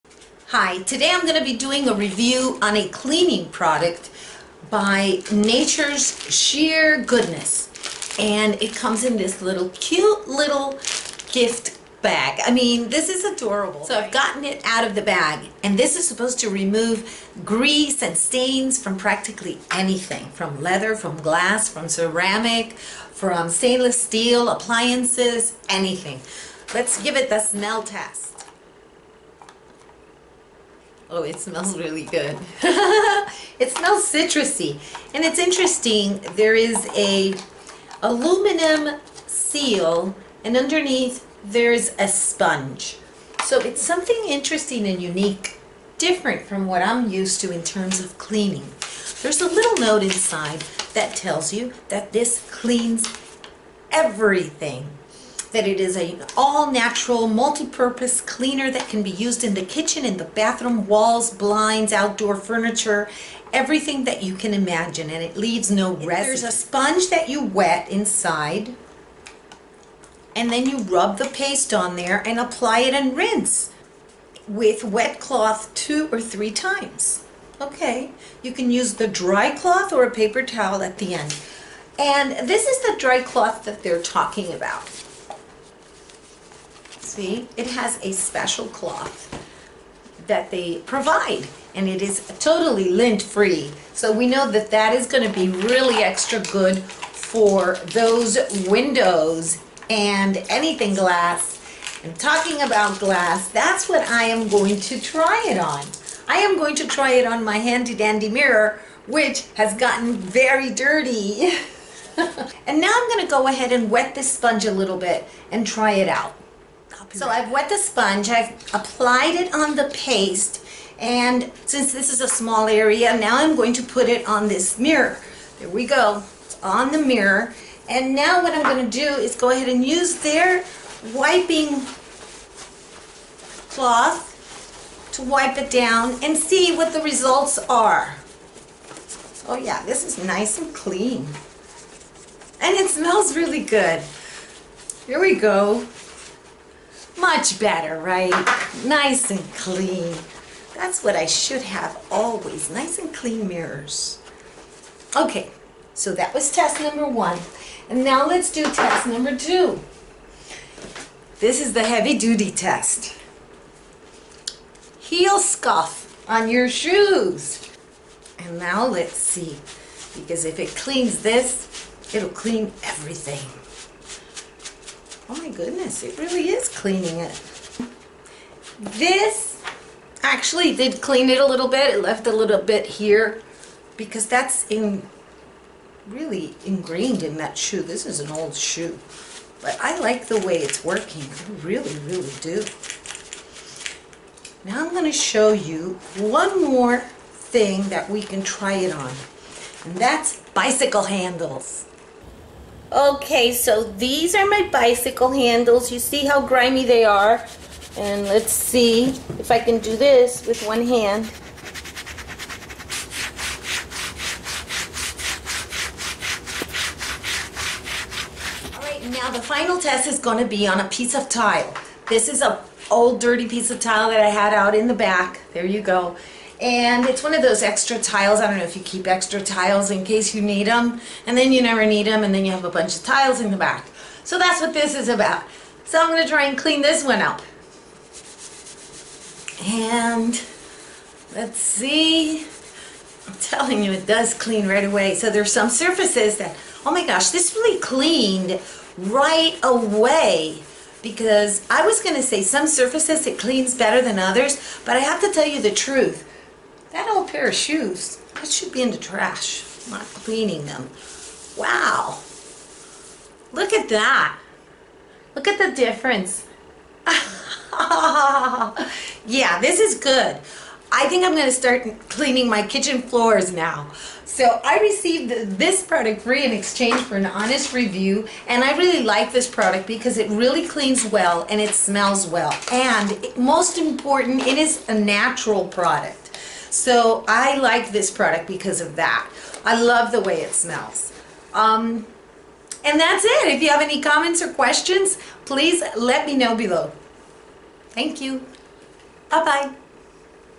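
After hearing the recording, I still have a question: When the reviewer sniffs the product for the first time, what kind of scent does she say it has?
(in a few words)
citrusy.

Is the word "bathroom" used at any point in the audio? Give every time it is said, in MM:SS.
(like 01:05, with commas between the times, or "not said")
01:00.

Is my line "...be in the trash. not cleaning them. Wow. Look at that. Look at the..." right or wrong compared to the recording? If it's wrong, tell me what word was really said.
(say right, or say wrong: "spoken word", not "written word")
right.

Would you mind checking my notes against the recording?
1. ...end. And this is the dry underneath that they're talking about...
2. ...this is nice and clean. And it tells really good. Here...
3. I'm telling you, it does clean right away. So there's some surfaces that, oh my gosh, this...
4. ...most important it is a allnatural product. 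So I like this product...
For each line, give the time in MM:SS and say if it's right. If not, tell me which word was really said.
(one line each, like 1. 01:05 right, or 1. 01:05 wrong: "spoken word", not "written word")
1. 01:21 wrong: "cloth", not "underneath"
2. 02:19 wrong: "smells", not "tells"
3. 04:03 right
4. 04:43 wrong: "natural", not "allnatural".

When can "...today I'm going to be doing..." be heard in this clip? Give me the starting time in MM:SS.
00:00.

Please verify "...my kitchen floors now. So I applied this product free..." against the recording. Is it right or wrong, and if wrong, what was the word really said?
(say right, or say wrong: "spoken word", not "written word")
wrong: "received", not "applied".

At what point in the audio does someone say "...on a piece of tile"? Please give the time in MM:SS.
03:40.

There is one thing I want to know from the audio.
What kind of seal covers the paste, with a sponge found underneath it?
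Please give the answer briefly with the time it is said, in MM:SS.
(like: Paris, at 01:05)
aluminum, at 00:38.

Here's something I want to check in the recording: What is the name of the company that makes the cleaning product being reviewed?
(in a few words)
Nature's Sheer Goodness.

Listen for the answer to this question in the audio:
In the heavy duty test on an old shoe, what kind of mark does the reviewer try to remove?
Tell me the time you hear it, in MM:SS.
02:44.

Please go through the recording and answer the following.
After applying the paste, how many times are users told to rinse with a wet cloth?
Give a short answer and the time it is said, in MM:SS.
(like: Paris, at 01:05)
2 or 3, at 01:15.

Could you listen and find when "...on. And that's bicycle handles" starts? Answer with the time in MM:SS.
03:18.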